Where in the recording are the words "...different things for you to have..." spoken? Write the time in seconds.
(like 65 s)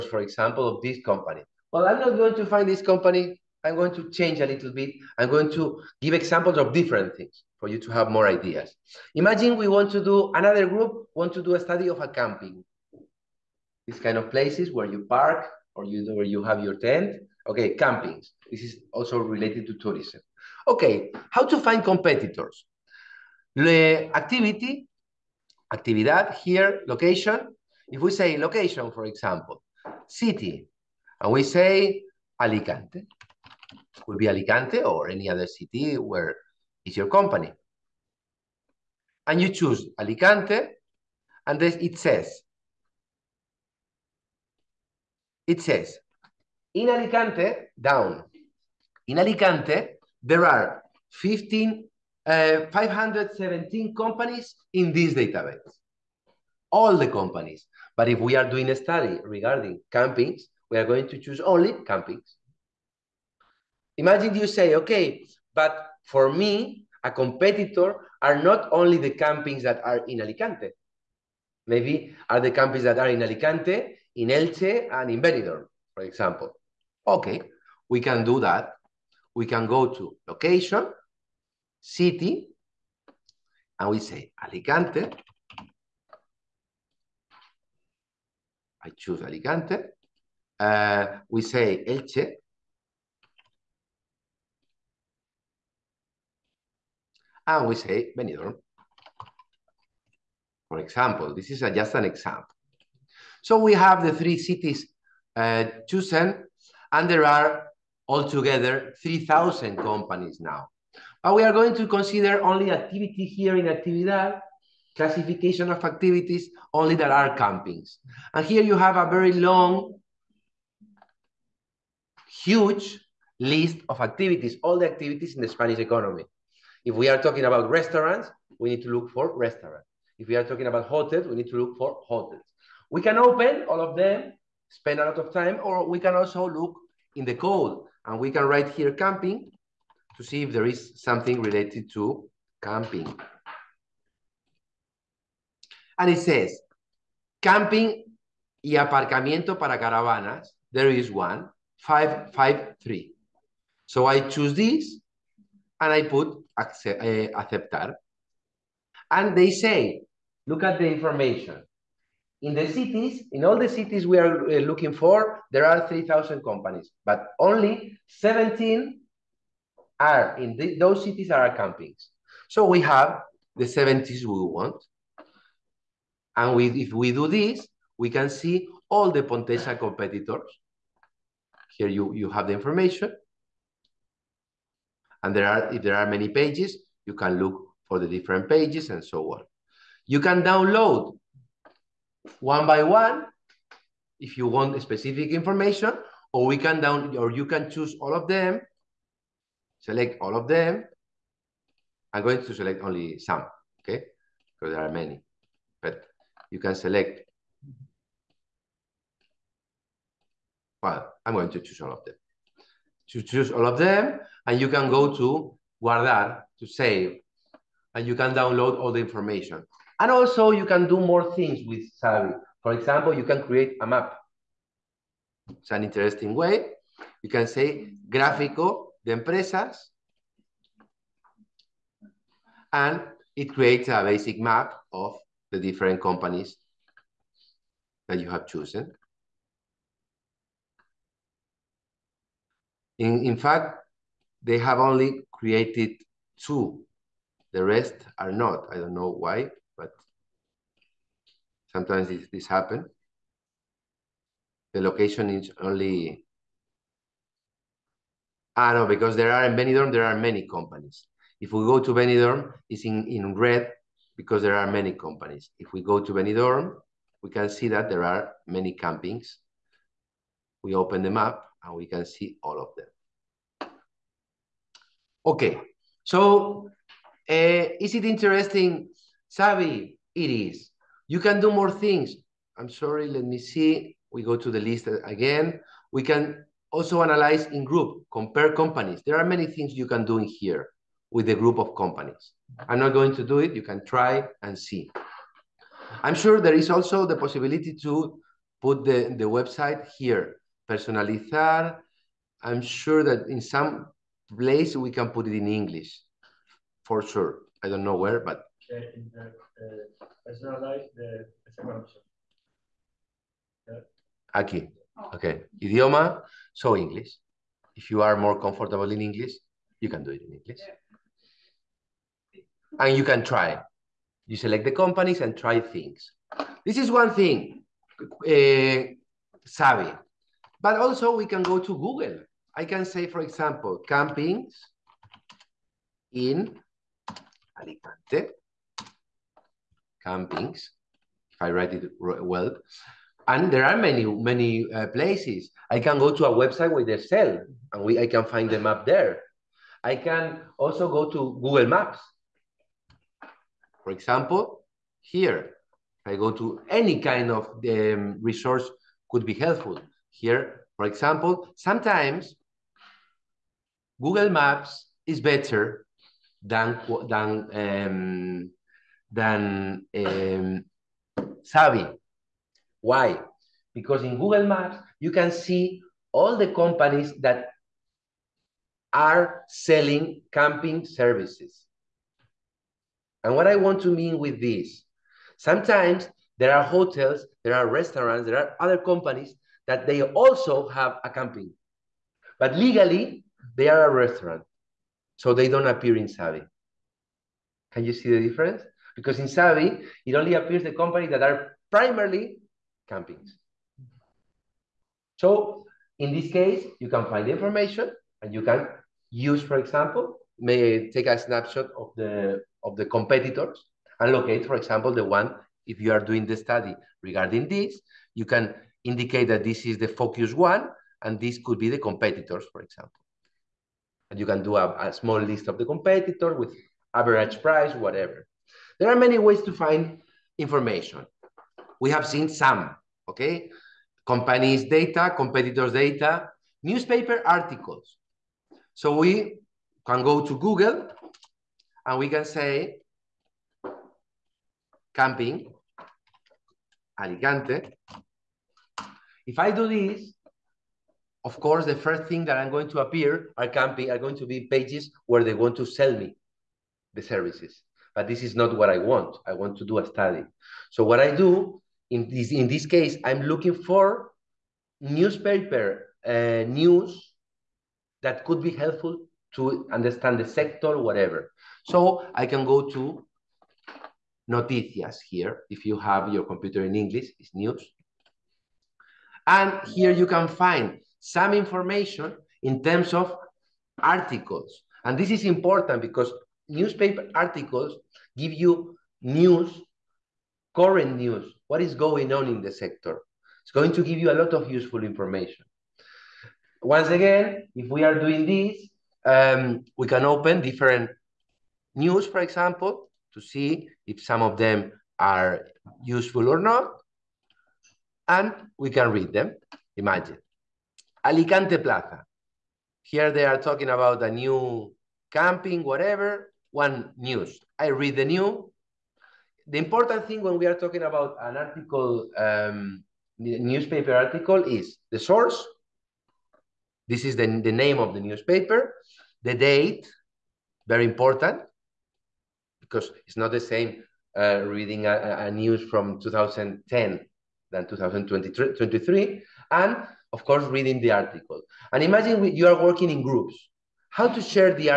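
6 s.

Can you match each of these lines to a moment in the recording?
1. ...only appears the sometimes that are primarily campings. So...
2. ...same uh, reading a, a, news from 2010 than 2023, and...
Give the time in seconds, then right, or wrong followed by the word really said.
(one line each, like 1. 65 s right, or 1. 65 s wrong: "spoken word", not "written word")
1. 400 s wrong: "companies", not "sometimes"
2. 533 s right.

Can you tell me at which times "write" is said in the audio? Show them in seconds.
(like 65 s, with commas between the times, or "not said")
138 s, 341 s.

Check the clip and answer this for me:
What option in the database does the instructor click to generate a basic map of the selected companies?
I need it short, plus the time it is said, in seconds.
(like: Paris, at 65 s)
gráfico de empresas, at 228 s.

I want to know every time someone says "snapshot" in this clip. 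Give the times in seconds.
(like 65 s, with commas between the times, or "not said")
411 s.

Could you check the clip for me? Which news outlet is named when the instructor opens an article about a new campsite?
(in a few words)
Alicante Plaza.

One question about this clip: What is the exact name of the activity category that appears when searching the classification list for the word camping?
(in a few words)
camping y aparcamiento para caravanas.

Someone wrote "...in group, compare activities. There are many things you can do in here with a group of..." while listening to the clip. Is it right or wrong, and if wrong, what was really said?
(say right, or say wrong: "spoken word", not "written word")
wrong: "companies", not "activities".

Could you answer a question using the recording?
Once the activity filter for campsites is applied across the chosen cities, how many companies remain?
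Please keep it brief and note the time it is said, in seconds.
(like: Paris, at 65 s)
17, at 167 s.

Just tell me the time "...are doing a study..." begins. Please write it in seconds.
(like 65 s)
58 s.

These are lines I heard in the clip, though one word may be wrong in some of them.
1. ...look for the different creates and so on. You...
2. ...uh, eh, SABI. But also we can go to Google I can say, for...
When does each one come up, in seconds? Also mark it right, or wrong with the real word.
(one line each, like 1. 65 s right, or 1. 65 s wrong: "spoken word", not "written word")
1. 187 s wrong: "pages", not "creates"
2. 328 s right.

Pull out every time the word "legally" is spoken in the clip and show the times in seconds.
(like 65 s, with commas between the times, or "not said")
392 s.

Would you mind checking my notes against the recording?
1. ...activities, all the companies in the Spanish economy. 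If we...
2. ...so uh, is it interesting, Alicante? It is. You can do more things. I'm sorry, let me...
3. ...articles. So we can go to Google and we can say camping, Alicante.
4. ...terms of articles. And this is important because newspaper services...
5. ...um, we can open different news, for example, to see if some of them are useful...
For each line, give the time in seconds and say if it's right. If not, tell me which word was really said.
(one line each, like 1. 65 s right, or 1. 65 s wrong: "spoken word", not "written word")
1. 123 s wrong: "activities", not "companies"
2. 276 s wrong: "SABI", not "Alicante"
3. 437 s right
4. 482 s wrong: "articles", not "services"
5. 499 s right.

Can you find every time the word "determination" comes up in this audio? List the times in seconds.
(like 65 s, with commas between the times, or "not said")
not said.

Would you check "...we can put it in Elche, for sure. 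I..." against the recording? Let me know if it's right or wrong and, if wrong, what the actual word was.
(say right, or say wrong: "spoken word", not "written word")
wrong: "English", not "Elche".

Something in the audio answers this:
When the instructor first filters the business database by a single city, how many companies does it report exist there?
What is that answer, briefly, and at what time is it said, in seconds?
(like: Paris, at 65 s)
517, at 52 s.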